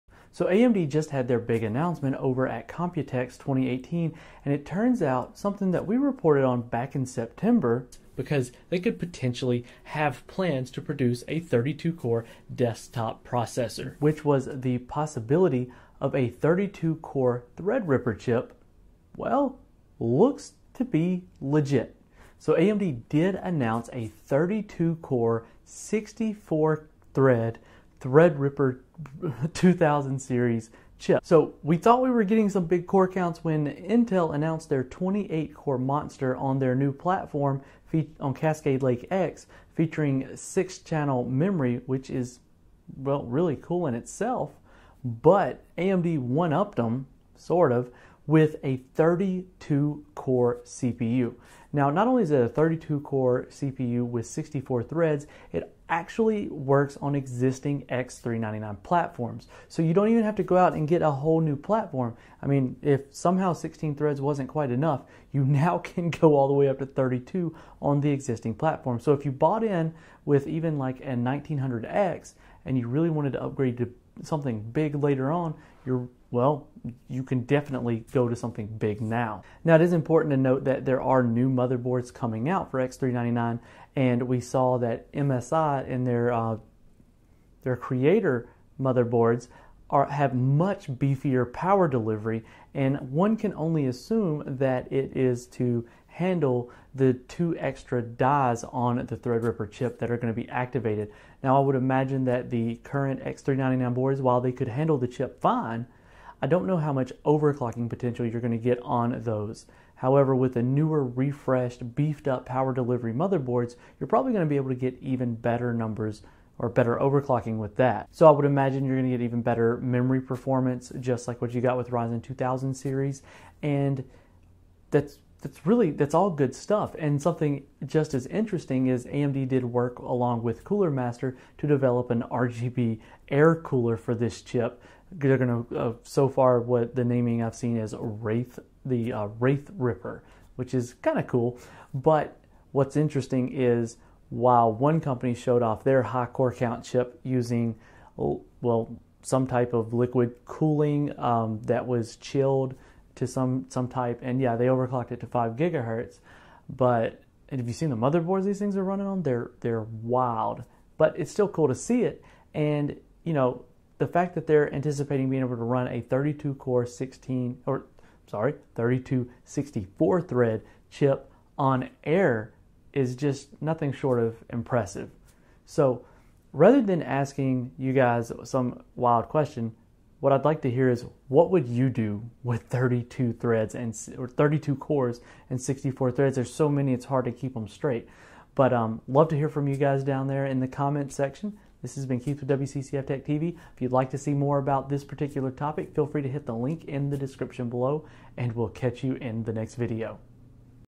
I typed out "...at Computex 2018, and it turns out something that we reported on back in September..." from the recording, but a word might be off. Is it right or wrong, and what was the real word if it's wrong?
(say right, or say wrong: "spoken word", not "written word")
right.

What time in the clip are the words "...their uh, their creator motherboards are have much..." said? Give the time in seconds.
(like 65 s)
86 s.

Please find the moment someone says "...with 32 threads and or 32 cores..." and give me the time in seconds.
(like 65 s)
182 s.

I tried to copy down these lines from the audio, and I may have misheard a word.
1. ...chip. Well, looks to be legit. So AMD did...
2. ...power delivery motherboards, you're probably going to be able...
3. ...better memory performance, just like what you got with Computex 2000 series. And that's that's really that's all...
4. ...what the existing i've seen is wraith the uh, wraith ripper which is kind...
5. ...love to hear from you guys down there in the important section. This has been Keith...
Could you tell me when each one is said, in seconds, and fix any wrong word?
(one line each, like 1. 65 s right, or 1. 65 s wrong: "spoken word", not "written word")
1. 18 s right
2. 112 s right
3. 119 s wrong: "Ryzen", not "Computex"
4. 136 s wrong: "naming", not "existing"
5. 189 s wrong: "comment", not "important".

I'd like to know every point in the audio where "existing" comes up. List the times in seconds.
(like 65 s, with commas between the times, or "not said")
57 s, 68 s.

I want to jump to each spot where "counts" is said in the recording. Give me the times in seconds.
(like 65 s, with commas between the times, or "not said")
33 s, 146 s.